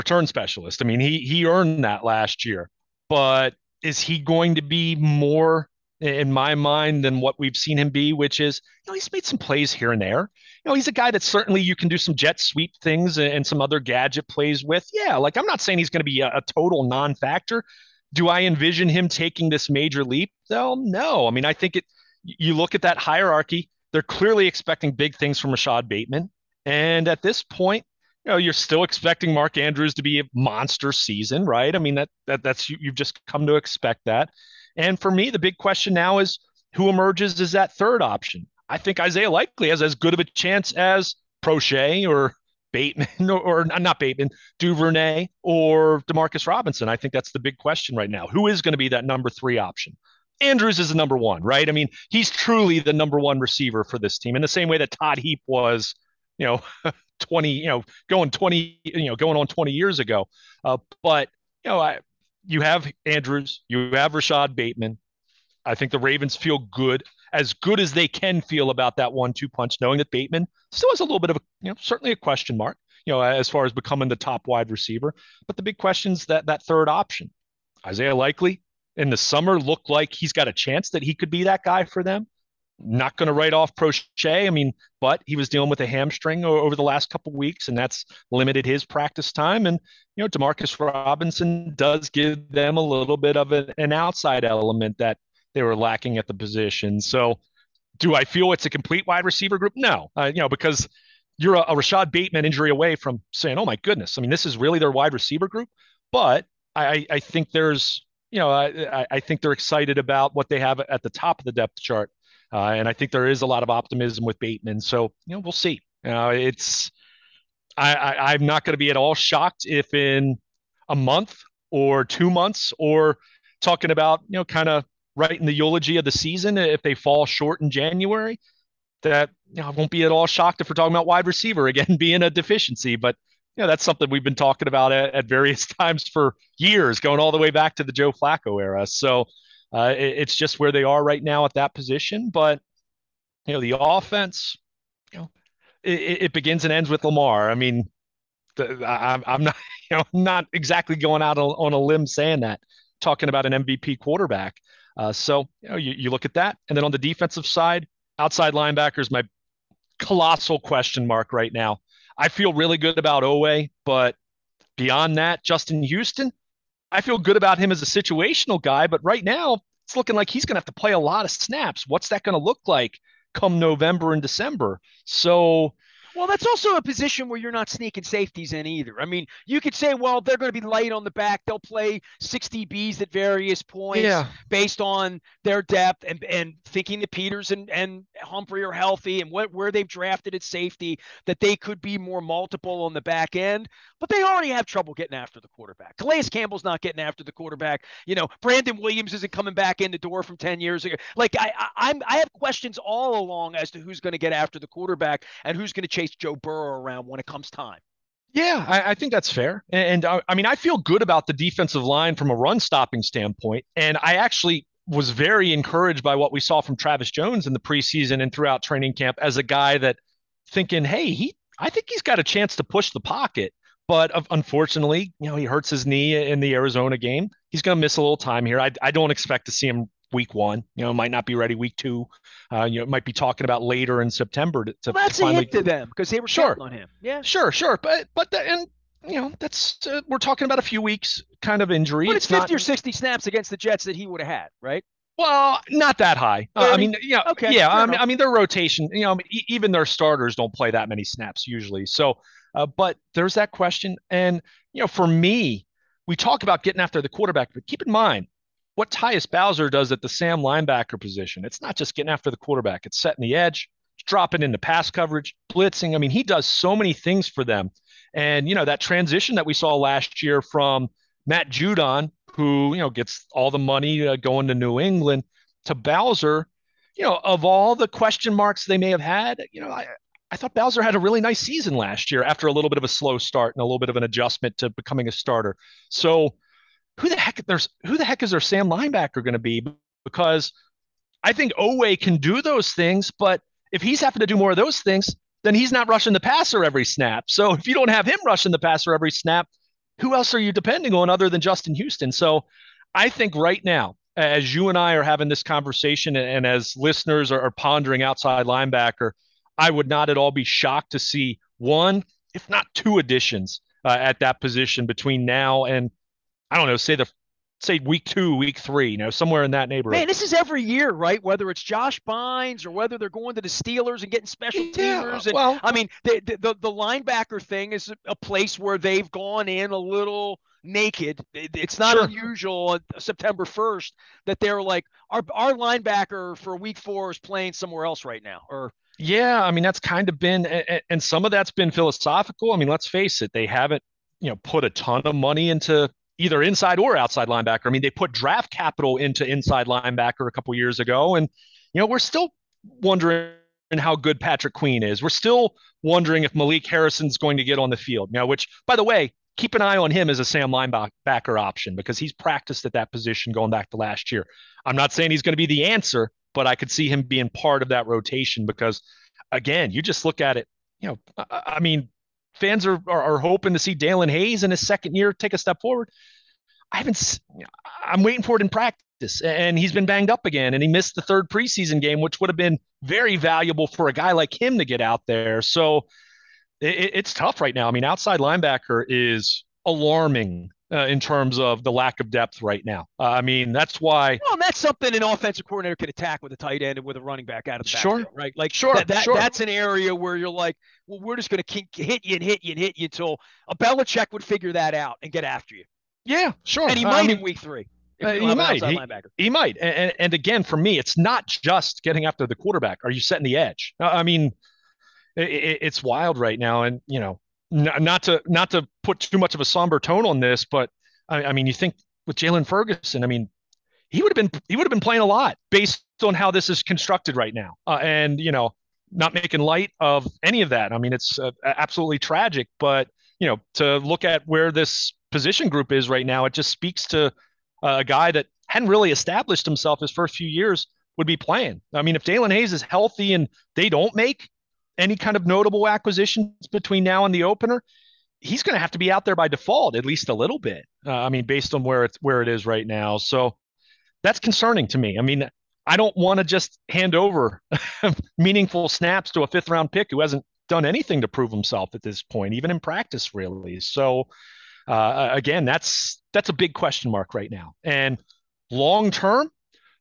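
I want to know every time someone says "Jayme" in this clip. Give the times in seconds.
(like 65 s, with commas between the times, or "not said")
not said.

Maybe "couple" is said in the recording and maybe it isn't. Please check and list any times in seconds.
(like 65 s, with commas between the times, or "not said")
87 s, 350 s.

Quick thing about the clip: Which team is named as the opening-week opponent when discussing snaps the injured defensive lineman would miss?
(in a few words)
Jets.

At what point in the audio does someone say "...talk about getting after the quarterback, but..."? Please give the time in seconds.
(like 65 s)
256 s.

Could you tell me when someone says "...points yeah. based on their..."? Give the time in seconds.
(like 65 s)
183 s.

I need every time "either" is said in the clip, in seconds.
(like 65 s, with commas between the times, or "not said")
178 s, 346 s.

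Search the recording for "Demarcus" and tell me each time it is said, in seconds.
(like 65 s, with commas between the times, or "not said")
46 s, 90 s.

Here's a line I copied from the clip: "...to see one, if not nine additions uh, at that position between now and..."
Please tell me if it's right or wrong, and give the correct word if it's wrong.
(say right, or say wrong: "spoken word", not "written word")
wrong: "two", not "nine".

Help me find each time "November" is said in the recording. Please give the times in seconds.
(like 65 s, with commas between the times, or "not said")
173 s.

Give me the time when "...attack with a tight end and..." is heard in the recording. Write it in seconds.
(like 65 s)
395 s.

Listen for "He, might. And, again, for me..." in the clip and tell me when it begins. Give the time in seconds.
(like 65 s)
409 s.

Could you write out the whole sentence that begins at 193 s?
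But they already have trouble getting after the quarterback.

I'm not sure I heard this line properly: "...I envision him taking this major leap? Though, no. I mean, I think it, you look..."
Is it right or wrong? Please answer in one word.
right.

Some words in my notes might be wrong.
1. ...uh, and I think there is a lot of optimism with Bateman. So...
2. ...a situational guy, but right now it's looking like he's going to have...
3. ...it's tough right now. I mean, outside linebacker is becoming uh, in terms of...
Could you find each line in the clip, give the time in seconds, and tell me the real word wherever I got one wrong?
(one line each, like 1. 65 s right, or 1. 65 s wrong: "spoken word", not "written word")
1. 112 s right
2. 167 s right
3. 386 s wrong: "alarming", not "becoming".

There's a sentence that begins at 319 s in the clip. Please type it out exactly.
Man, this is every year, right?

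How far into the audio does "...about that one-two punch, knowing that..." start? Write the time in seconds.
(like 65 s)
68 s.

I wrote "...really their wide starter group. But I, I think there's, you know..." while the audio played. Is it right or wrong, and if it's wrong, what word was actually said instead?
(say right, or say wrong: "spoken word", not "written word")
wrong: "receiver", not "starter".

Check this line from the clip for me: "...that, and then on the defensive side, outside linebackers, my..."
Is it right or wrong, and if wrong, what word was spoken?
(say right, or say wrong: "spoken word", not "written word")
right.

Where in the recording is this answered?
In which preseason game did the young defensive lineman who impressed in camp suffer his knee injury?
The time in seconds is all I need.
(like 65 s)
226 s.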